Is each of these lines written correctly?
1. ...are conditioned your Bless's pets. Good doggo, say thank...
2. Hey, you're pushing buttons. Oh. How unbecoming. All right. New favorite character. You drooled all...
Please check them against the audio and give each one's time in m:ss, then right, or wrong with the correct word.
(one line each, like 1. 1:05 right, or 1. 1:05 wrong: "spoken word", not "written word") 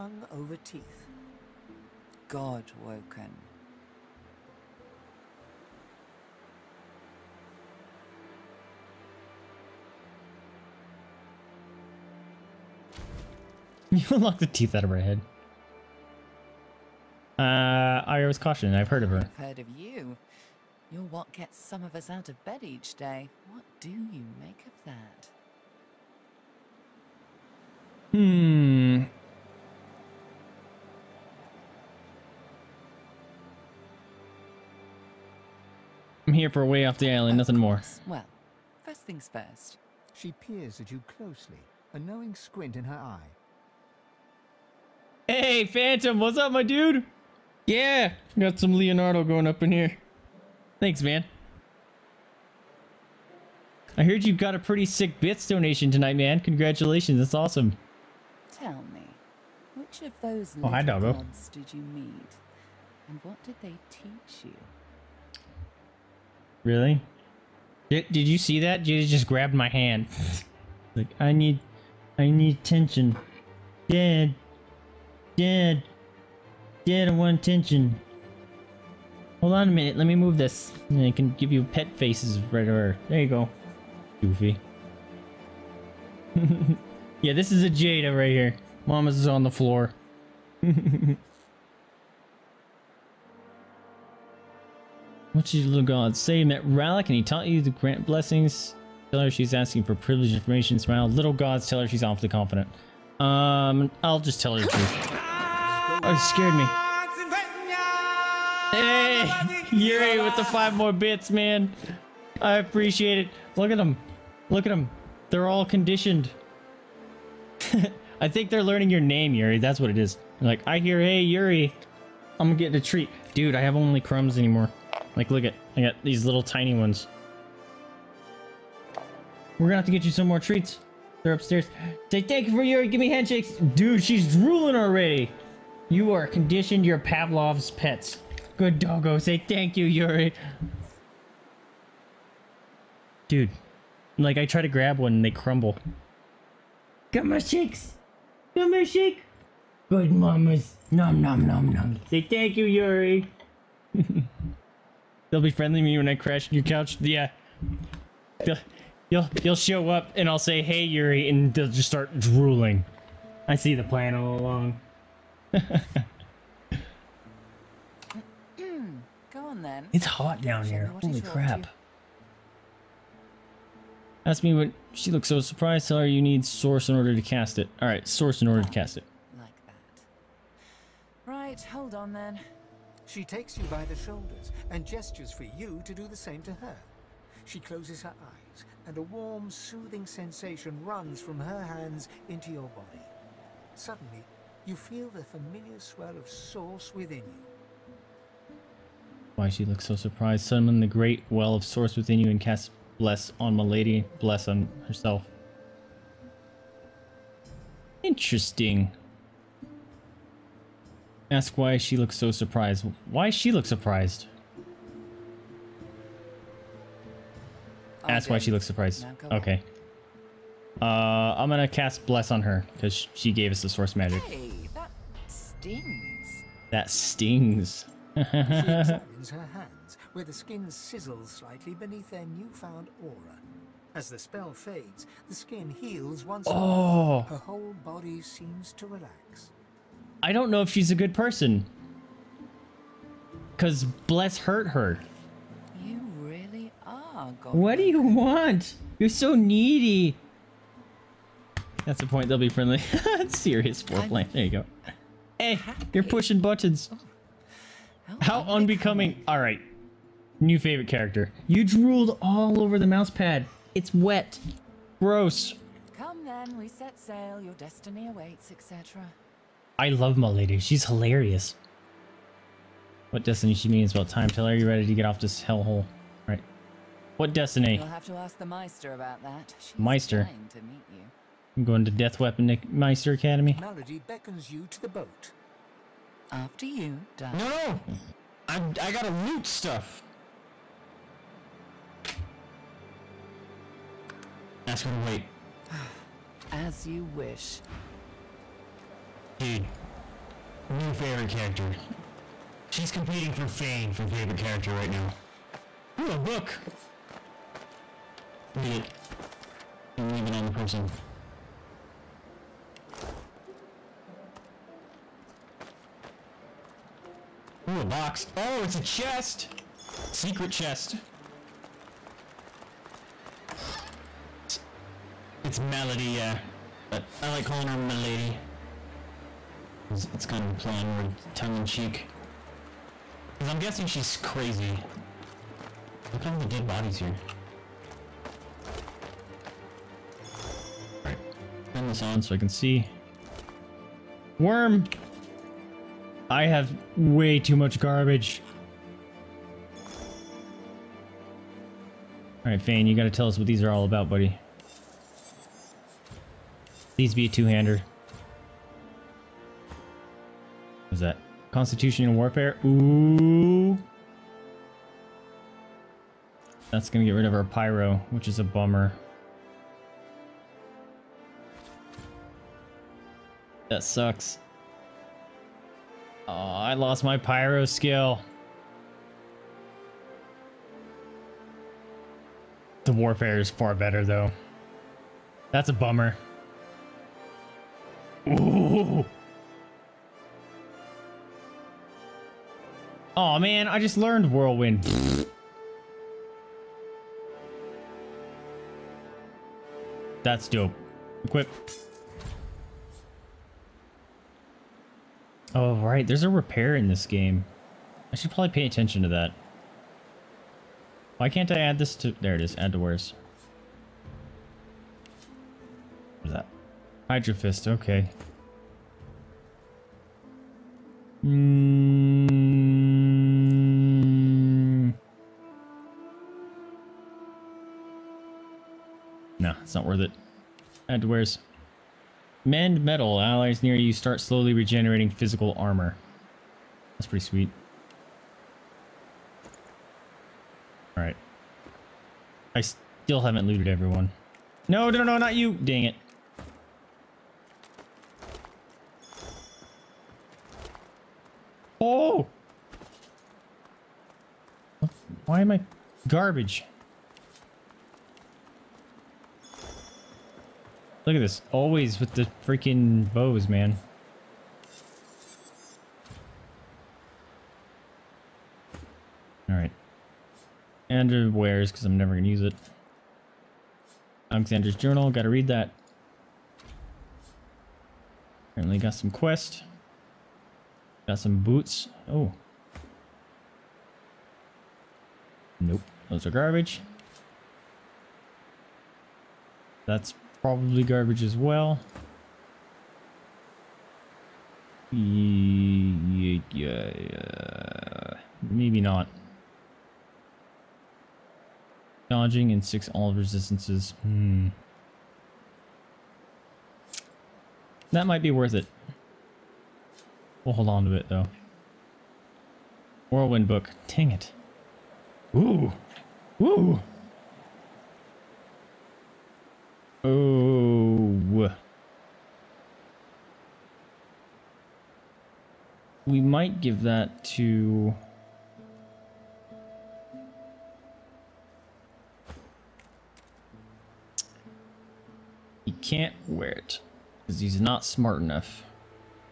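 1. 2:16 wrong: "Pavlov", not "Bless"
2. 4:15 right.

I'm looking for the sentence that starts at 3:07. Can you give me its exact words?
She closes her eyes and a warm, soothing sensation runs from her hands into your body.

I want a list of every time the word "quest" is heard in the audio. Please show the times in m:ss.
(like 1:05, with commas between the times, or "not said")
7:59.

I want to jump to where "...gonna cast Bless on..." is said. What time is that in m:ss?
3:41.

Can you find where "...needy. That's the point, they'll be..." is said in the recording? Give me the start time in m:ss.
4:09.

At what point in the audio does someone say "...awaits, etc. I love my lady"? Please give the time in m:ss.
4:28.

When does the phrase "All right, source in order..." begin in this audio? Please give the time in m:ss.
2:57.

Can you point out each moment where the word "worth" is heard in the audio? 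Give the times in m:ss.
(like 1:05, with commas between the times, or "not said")
7:09, 8:28.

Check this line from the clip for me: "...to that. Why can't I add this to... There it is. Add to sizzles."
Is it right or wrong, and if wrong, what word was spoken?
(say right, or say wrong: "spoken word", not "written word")
wrong: "wares", not "sizzles".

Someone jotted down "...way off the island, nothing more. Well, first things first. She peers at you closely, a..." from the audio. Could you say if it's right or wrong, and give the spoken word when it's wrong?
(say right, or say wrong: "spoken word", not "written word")
right.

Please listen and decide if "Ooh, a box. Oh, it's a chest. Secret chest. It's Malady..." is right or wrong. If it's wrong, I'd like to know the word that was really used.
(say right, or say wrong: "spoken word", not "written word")
right.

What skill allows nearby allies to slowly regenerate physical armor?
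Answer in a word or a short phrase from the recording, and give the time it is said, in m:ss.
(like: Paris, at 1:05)
Mend Metal, at 7:12.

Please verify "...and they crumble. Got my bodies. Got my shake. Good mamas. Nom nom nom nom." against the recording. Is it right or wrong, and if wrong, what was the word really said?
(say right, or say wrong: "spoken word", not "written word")
wrong: "shakes", not "bodies".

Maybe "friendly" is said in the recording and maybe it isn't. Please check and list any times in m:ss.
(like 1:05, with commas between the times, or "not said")
2:35, 4:12.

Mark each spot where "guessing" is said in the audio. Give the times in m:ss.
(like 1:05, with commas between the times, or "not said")
5:33.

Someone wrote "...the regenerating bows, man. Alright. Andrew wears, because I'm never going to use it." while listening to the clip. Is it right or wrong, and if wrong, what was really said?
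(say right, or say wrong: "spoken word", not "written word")
wrong: "freaking", not "regenerating".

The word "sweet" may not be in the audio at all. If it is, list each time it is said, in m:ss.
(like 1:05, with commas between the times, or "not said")
7:17.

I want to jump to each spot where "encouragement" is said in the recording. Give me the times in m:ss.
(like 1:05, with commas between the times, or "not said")
not said.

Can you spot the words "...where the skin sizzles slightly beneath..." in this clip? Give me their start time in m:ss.
3:50.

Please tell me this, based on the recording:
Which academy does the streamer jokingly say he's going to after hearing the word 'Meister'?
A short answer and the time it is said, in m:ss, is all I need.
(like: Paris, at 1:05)
Death Weapon Meister Academy, at 4:41.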